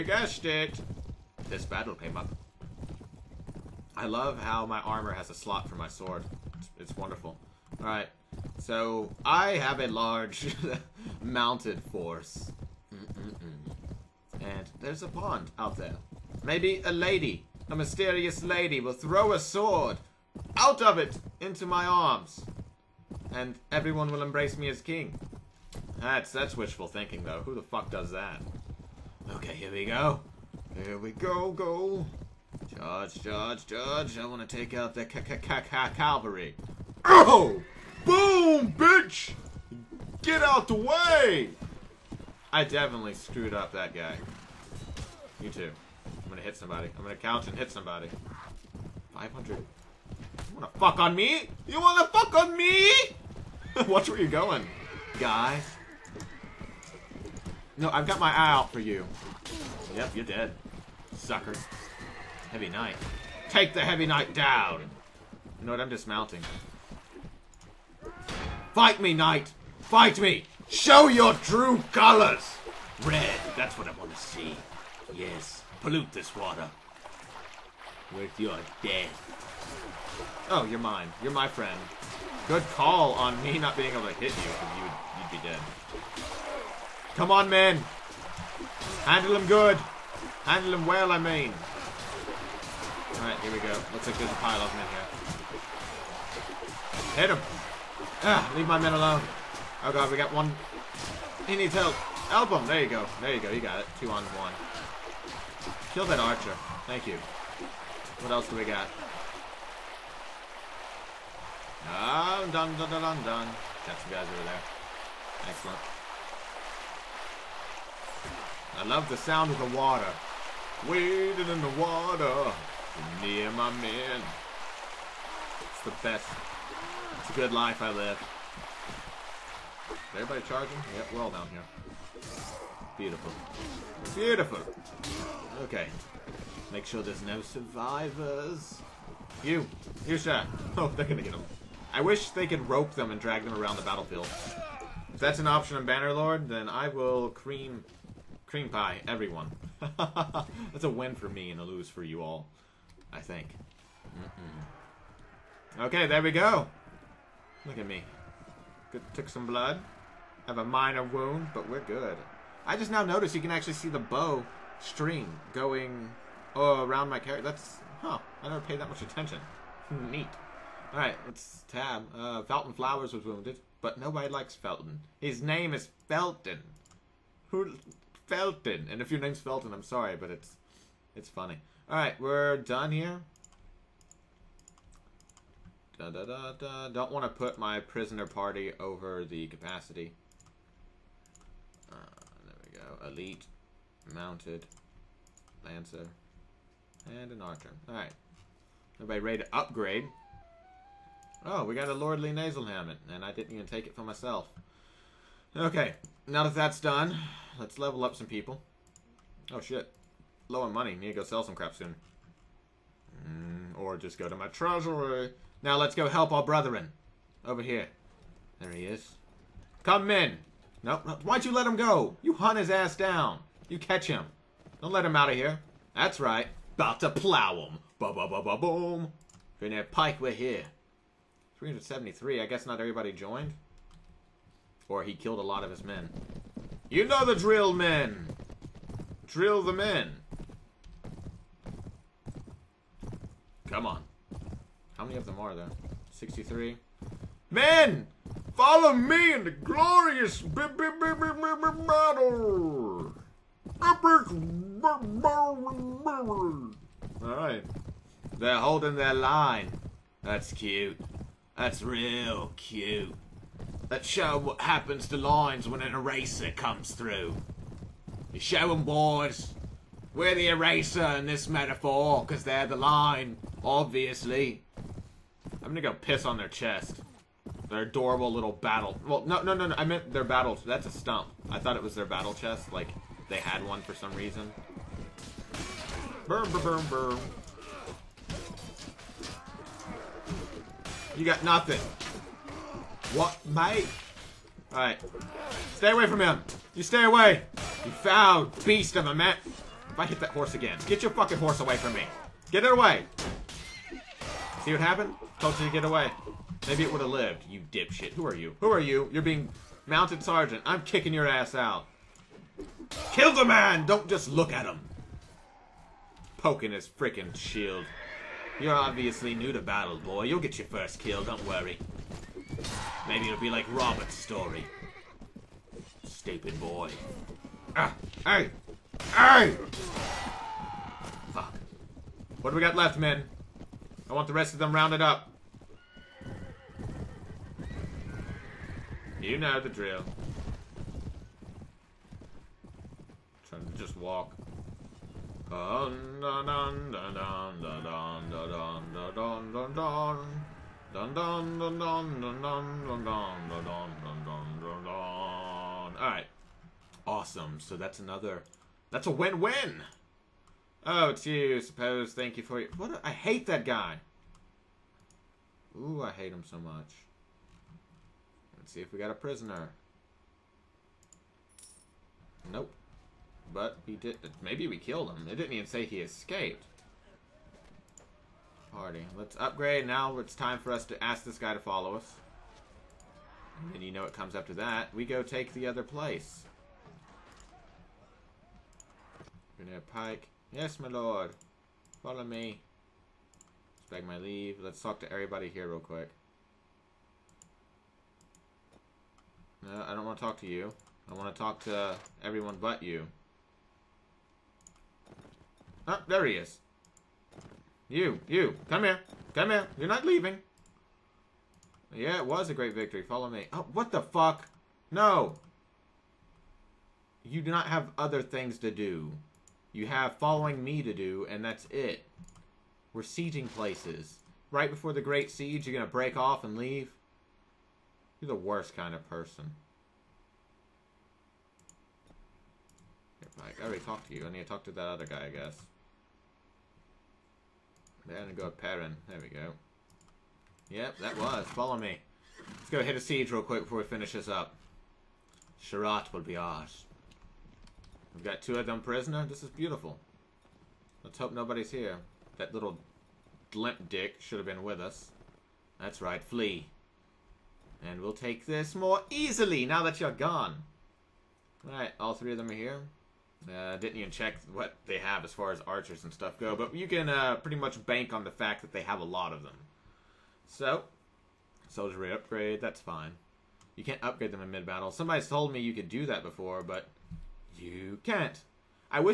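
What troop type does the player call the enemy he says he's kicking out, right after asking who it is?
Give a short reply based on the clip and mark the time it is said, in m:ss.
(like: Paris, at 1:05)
mounted sergeant, at 5:09.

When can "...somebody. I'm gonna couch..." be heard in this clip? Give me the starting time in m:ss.
0:46.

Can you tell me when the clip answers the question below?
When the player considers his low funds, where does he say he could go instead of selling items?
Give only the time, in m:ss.
3:34.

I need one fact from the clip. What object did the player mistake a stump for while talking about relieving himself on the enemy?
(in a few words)
battle chest.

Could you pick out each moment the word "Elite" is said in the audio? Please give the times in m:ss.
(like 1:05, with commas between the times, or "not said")
3:13.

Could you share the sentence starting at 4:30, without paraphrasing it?
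We're the eraser in this metaphor, because they're the line, obviously.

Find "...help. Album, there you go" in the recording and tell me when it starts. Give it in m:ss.
1:41.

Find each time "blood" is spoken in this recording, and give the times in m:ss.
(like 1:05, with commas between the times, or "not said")
2:39.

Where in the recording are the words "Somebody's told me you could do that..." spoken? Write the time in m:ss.
7:54.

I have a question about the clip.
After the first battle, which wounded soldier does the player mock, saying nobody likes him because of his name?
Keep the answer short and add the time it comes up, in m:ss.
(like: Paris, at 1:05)
Felton Flowers, at 2:52.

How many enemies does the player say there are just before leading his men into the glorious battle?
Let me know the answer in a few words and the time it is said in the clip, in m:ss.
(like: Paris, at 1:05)
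63, at 4:06.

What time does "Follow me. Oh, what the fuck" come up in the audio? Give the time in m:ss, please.
6:53.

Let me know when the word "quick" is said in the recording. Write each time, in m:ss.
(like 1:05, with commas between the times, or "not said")
6:35, 7:23.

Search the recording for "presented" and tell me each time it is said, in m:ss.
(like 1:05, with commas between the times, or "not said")
not said.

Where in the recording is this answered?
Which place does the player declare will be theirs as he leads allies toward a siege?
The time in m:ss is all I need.
7:25.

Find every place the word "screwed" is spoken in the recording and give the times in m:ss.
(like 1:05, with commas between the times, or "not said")
0:43.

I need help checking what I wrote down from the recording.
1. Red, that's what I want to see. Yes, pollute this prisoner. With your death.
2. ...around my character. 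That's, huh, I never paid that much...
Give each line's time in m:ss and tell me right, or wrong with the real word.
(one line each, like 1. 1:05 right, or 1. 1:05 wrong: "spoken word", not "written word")
1. 1:13 wrong: "water", not "prisoner"
2. 2:46 right.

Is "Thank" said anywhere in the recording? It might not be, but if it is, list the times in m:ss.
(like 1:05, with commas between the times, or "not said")
1:46, 6:02.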